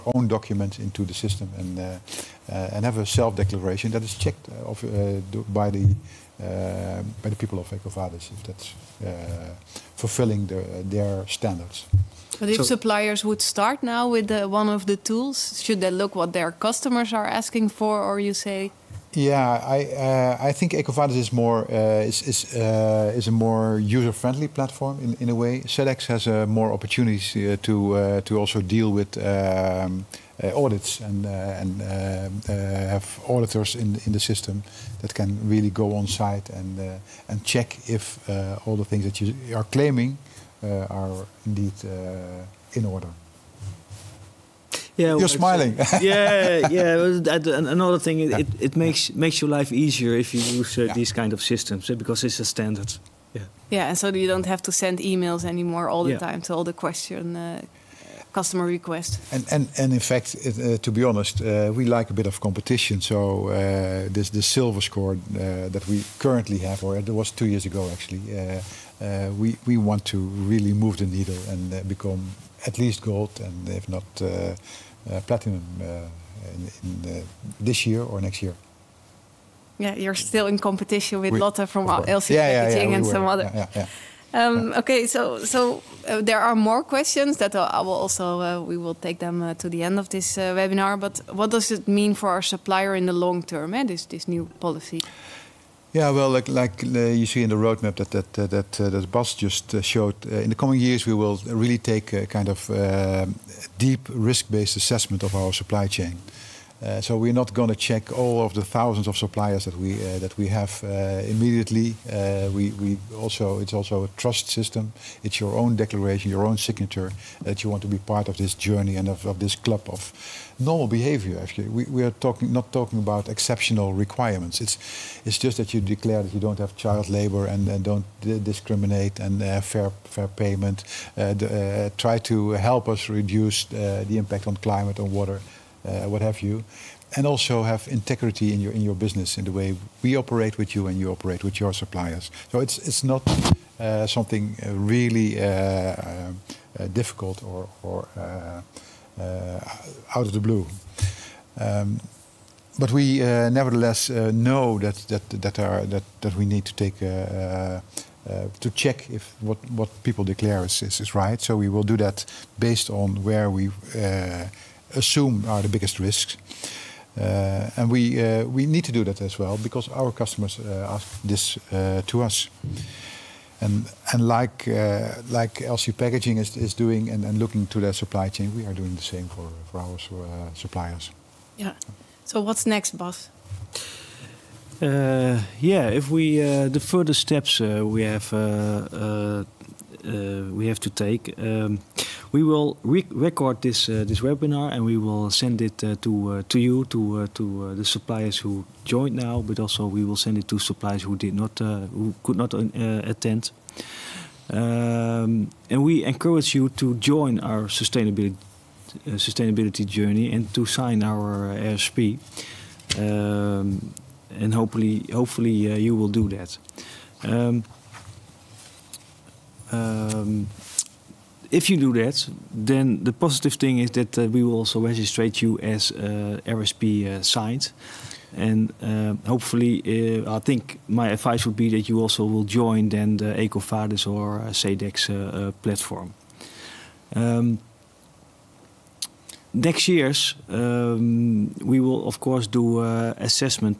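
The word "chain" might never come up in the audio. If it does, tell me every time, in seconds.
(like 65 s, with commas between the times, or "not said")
105 s, 178 s.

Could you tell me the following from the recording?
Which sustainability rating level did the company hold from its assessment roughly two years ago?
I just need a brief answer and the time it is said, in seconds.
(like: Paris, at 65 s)
Silver, at 64 s.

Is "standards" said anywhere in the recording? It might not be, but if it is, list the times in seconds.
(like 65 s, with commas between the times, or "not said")
11 s, 52 s.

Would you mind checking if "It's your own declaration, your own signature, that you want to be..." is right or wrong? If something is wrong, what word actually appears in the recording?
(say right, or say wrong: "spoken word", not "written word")
right.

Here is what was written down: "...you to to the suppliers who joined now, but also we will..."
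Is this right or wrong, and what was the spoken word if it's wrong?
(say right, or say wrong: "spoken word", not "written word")
right.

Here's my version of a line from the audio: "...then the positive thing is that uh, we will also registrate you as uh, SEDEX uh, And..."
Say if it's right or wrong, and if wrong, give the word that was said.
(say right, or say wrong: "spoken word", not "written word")
wrong: "RSP", not "SEDEX".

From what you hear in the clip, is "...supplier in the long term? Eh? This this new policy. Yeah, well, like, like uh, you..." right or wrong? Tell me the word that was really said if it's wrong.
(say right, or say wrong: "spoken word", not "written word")
right.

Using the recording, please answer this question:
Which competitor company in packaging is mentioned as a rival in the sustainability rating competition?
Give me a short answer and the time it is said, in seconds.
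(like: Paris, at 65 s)
LC Packaging, at 81 s.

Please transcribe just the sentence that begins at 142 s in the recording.
So it's it's not uh, something uh, really uh, uh, difficult or or uh, out of the blue.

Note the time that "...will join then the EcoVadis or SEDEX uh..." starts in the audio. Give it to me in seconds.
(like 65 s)
232 s.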